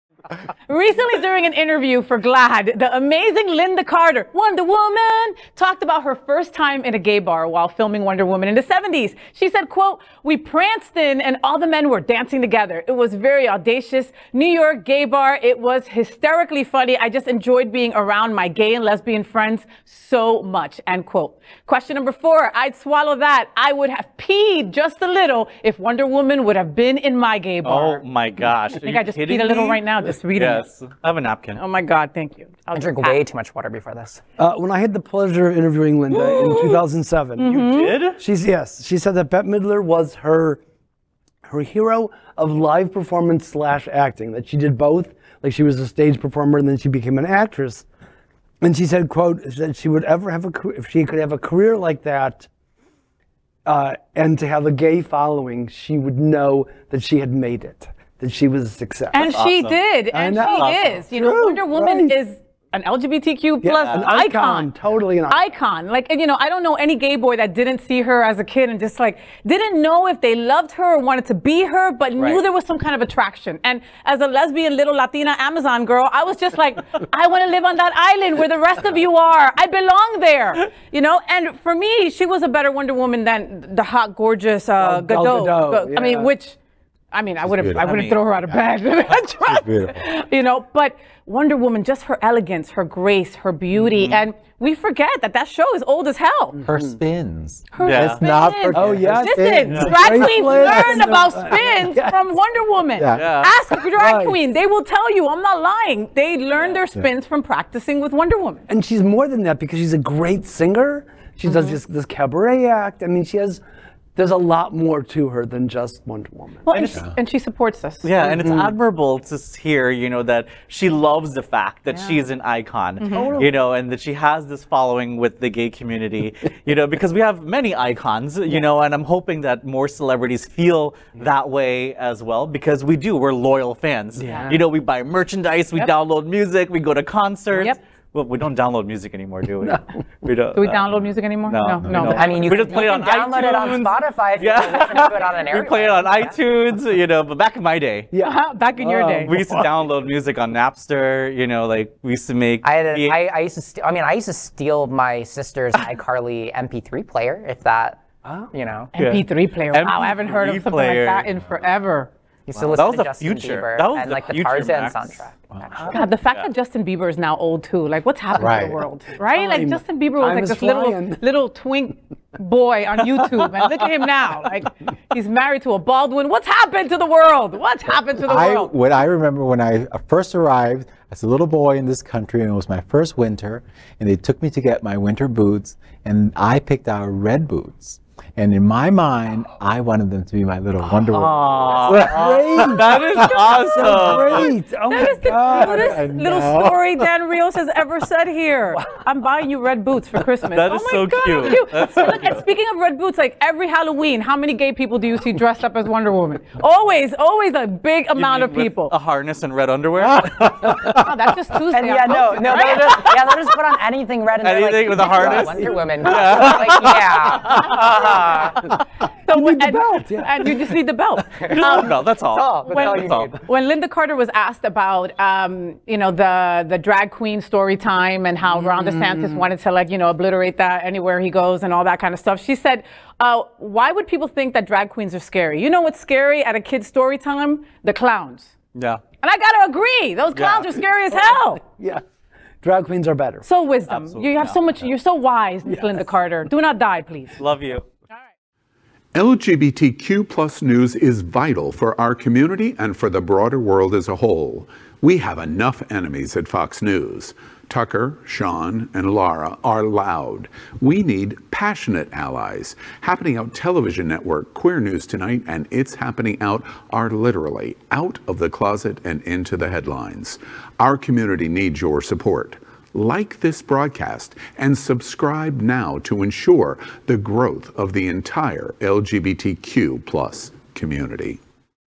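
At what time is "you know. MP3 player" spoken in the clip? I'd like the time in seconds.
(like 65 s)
158 s.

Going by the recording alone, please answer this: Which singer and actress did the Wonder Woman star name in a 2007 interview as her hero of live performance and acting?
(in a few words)
Bette Midler.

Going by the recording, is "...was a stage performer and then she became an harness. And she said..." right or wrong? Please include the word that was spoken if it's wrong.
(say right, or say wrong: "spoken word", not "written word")
wrong: "actress", not "harness".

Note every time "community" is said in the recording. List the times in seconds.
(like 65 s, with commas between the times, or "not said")
125 s, 252 s, 270 s, 280 s.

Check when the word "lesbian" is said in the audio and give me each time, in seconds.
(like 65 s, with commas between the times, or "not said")
18 s, 74 s.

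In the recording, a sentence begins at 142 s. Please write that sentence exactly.
I mean, you we can, just play it on download iTunes.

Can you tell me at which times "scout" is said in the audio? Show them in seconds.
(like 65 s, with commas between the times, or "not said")
not said.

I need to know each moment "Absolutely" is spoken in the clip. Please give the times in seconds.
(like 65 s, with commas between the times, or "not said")
244 s.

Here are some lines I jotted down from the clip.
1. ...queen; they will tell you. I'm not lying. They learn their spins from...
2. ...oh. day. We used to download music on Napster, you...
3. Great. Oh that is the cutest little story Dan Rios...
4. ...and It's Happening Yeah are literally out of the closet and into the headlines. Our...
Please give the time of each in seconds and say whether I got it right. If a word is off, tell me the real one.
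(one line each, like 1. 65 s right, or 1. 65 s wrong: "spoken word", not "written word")
1. 104 s right
2. 149 s right
3. 194 s right
4. 265 s wrong: "Out", not "Yeah".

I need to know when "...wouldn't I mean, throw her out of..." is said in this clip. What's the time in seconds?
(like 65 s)
87 s.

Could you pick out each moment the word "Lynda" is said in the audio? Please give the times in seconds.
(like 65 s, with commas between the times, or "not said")
3 s, 35 s, 223 s, 245 s.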